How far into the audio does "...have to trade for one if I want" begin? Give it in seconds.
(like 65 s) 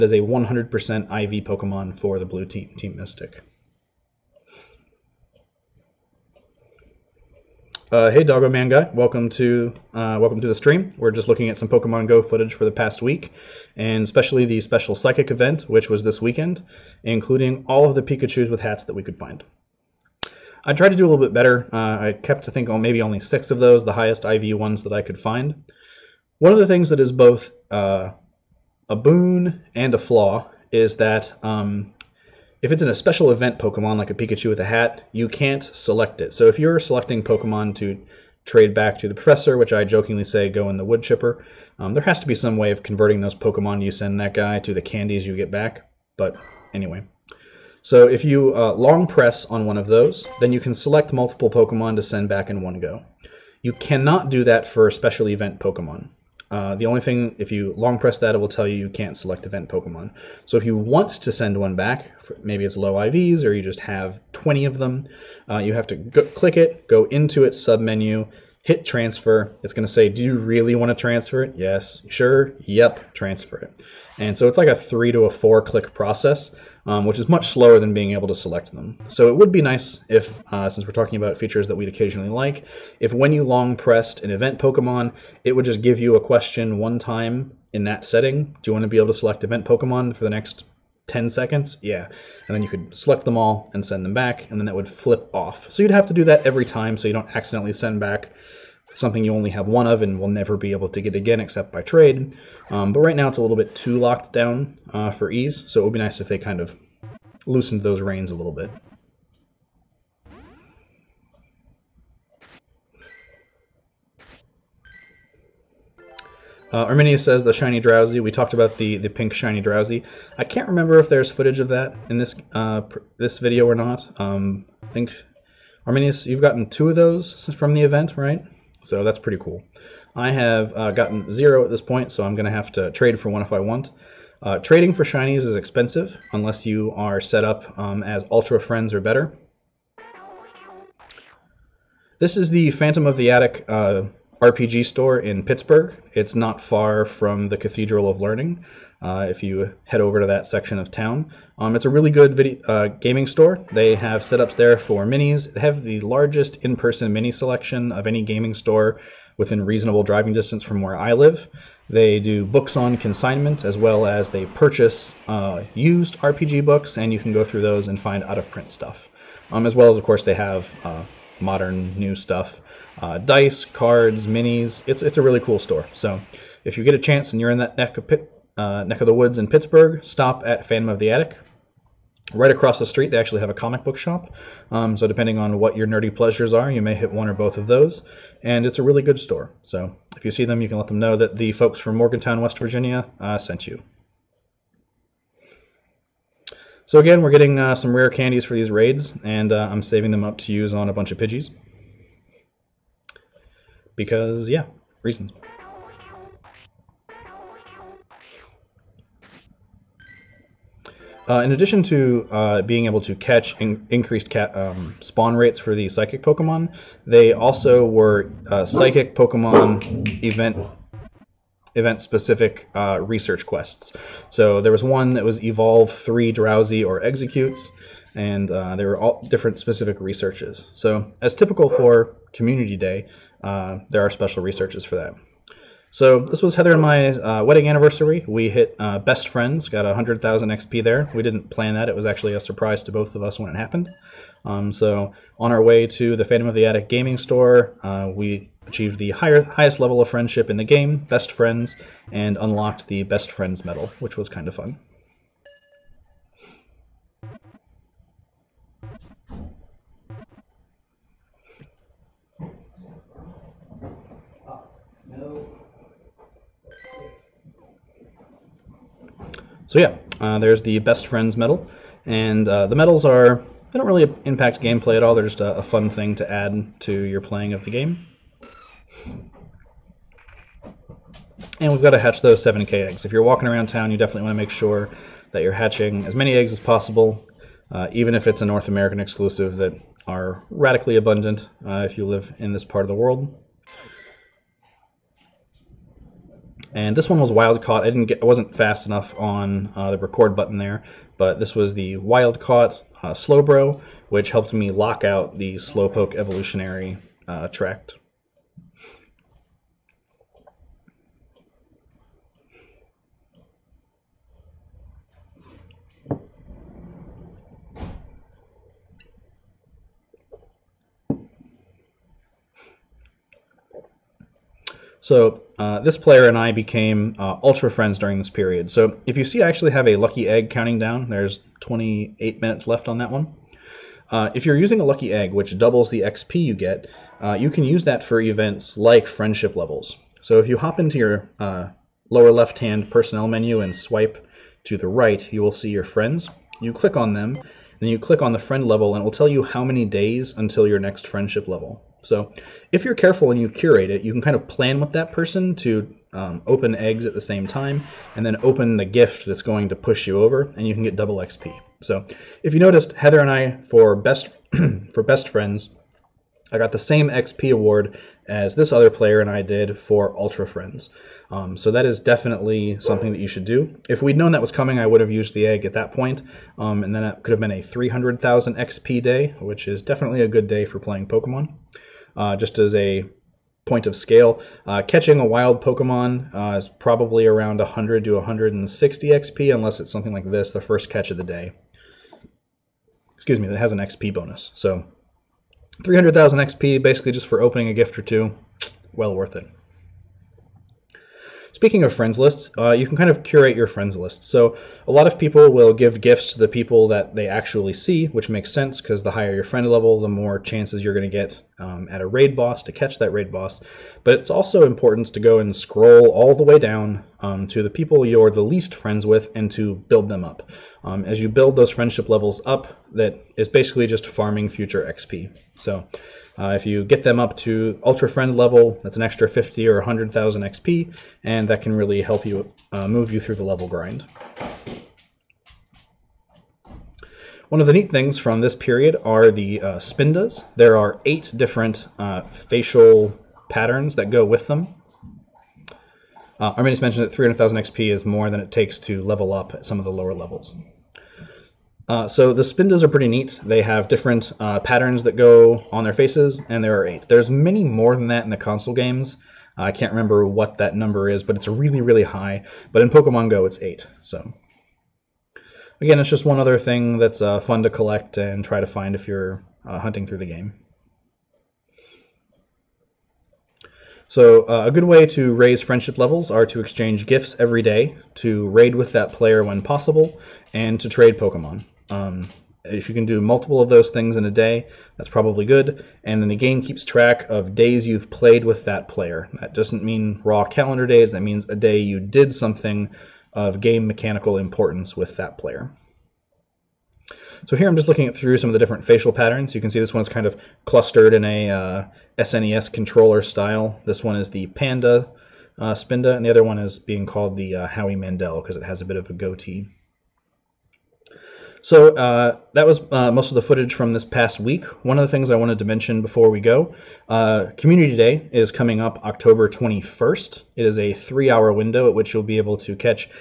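132 s.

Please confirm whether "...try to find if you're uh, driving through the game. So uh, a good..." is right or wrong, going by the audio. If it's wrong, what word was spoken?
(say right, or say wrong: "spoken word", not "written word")
wrong: "hunting", not "driving".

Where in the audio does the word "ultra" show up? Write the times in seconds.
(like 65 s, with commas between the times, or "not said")
138 s, 327 s, 370 s, 427 s.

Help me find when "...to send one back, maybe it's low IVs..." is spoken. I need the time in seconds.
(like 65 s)
61 s.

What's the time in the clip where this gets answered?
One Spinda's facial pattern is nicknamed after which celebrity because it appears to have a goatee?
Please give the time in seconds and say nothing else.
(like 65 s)
507 s.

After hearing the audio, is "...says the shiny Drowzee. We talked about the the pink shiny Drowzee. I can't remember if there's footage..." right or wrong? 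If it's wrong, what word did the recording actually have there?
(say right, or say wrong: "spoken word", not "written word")
right.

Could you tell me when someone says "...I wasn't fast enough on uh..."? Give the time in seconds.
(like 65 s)
298 s.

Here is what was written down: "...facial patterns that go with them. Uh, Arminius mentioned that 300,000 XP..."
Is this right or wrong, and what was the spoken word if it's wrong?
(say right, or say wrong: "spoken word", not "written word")
right.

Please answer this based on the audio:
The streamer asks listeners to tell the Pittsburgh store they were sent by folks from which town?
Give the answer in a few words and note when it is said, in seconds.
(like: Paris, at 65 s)
Morgantown, West Virginia, at 191 s.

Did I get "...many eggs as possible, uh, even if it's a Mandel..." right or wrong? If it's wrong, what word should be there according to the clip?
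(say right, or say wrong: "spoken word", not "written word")
wrong: "North", not "Mandel".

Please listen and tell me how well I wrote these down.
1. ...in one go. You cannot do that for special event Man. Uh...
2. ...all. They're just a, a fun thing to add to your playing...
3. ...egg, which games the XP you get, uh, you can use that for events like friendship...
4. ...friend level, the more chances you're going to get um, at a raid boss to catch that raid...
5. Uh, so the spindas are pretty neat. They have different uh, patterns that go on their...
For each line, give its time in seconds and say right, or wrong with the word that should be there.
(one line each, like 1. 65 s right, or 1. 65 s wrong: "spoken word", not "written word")
1. 52 s wrong: "Pokemon", not "Man"
2. 275 s right
3. 335 s wrong: "doubles", not "games"
4. 409 s right
5. 451 s right.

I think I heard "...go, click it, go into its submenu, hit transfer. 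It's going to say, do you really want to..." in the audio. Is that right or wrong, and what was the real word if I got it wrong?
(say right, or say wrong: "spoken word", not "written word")
right.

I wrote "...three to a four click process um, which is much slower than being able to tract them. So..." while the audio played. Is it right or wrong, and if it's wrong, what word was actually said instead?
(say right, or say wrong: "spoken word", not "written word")
wrong: "select", not "tract".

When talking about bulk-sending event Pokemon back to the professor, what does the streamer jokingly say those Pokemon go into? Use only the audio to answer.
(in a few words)
the wood chipper.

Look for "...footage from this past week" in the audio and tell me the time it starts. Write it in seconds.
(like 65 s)
513 s.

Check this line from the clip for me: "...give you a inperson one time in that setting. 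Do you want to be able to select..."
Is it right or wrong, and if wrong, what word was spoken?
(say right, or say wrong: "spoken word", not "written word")
wrong: "question", not "inperson".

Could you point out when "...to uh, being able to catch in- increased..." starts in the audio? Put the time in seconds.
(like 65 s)
211 s.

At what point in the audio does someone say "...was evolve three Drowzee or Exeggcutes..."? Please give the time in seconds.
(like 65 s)
225 s.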